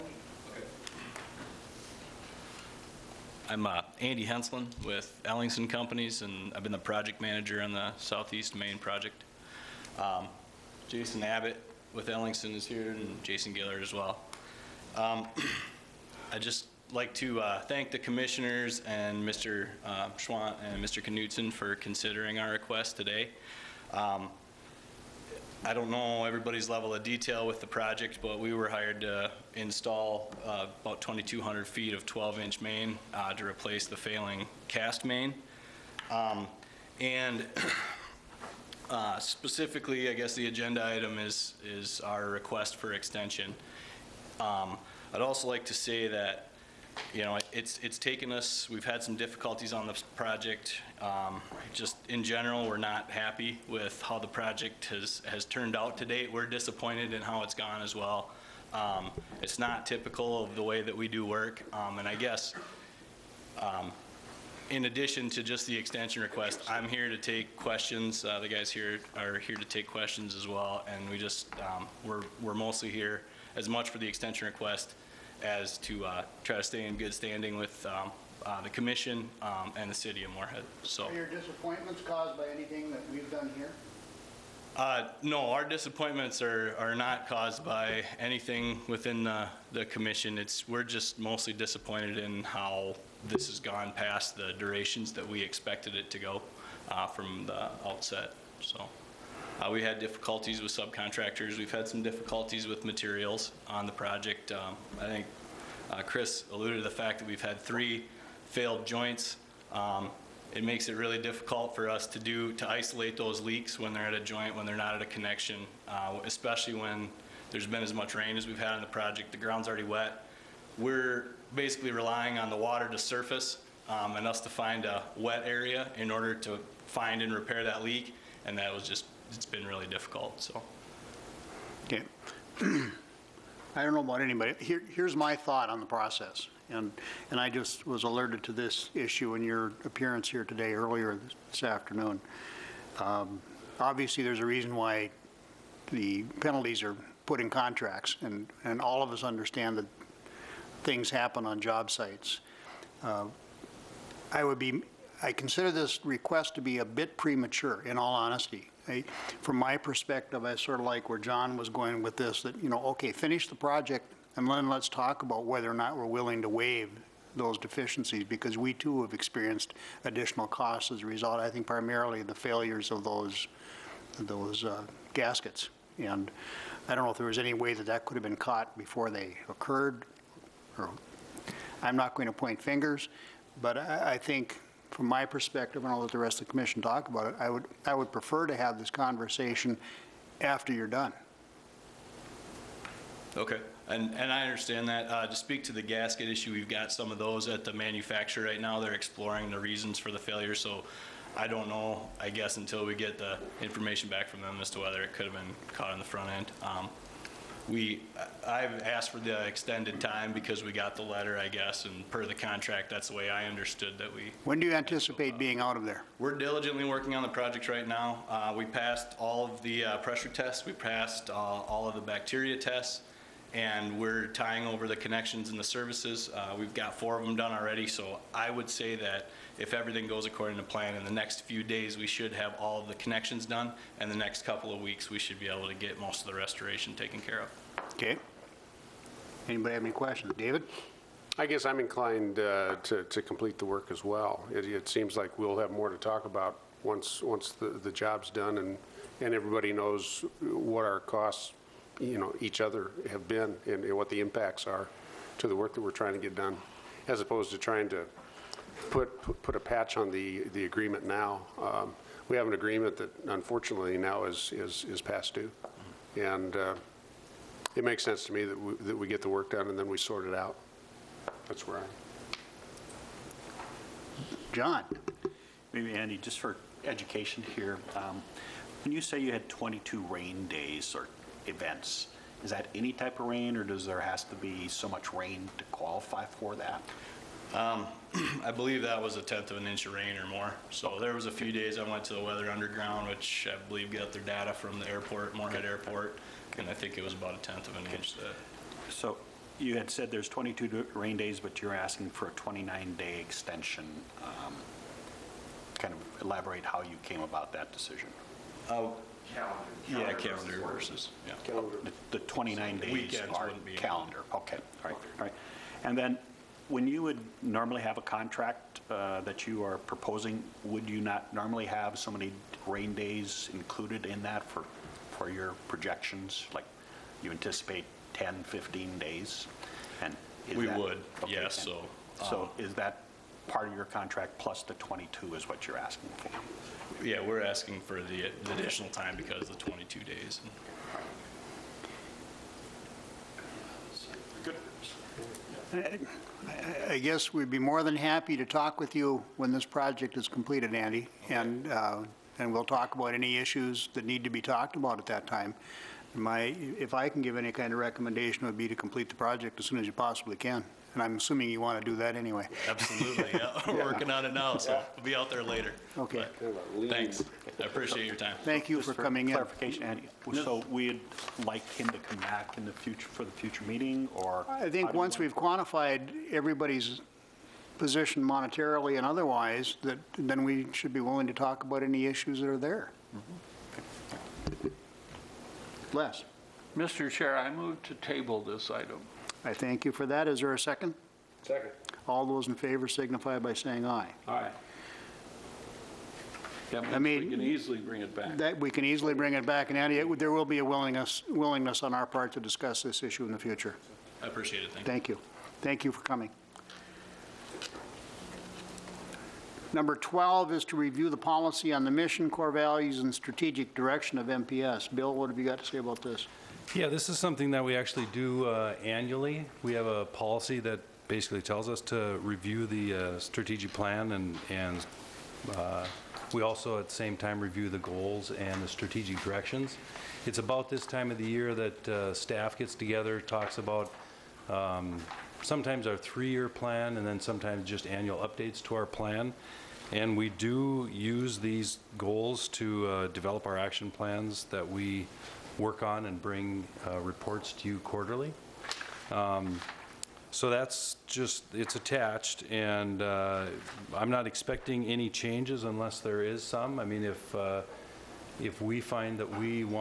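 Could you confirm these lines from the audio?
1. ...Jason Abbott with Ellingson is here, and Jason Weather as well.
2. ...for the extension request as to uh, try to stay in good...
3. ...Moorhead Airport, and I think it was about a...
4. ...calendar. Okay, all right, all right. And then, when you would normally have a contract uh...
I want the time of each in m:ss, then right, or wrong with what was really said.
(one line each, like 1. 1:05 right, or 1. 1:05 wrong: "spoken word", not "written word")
1. 0:10 wrong: "Gillard", not "Weather"
2. 1:13 right
3. 4:55 right
4. 5:13 right.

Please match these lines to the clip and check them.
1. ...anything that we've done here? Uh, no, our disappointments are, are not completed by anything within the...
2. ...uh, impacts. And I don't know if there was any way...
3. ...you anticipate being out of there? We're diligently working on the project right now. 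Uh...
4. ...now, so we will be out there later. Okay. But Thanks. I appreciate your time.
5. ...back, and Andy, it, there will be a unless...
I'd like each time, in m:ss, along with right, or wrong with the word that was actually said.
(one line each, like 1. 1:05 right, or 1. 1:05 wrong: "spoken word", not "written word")
1. 1:22 wrong: "caused", not "completed"
2. 2:54 wrong: "gaskets", not "impacts"
3. 3:34 right
4. 6:04 right
5. 6:39 wrong: "willingness", not "unless".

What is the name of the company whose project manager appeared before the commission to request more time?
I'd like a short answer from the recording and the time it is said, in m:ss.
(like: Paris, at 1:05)
Ellingson Companies, at 0:05.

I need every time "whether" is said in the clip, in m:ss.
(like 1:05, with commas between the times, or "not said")
2:45, 3:24.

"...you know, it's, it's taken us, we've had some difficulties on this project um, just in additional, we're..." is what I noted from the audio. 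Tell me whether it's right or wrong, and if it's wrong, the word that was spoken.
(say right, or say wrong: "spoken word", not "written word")
wrong: "general", not "additional".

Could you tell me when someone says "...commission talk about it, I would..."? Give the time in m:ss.
3:06.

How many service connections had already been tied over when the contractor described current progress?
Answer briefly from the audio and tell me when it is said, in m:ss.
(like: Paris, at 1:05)
4, at 3:46.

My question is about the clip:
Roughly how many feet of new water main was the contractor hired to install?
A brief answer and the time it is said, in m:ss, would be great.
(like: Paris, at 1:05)
2,200, at 0:31.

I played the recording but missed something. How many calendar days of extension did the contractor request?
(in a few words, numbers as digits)
29.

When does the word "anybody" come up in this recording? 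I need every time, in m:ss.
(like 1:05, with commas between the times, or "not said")
2:14, 3:59.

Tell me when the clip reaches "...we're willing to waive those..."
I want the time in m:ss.
2:45.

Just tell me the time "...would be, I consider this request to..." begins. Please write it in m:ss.
2:34.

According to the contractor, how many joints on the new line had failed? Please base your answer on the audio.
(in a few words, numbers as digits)
3.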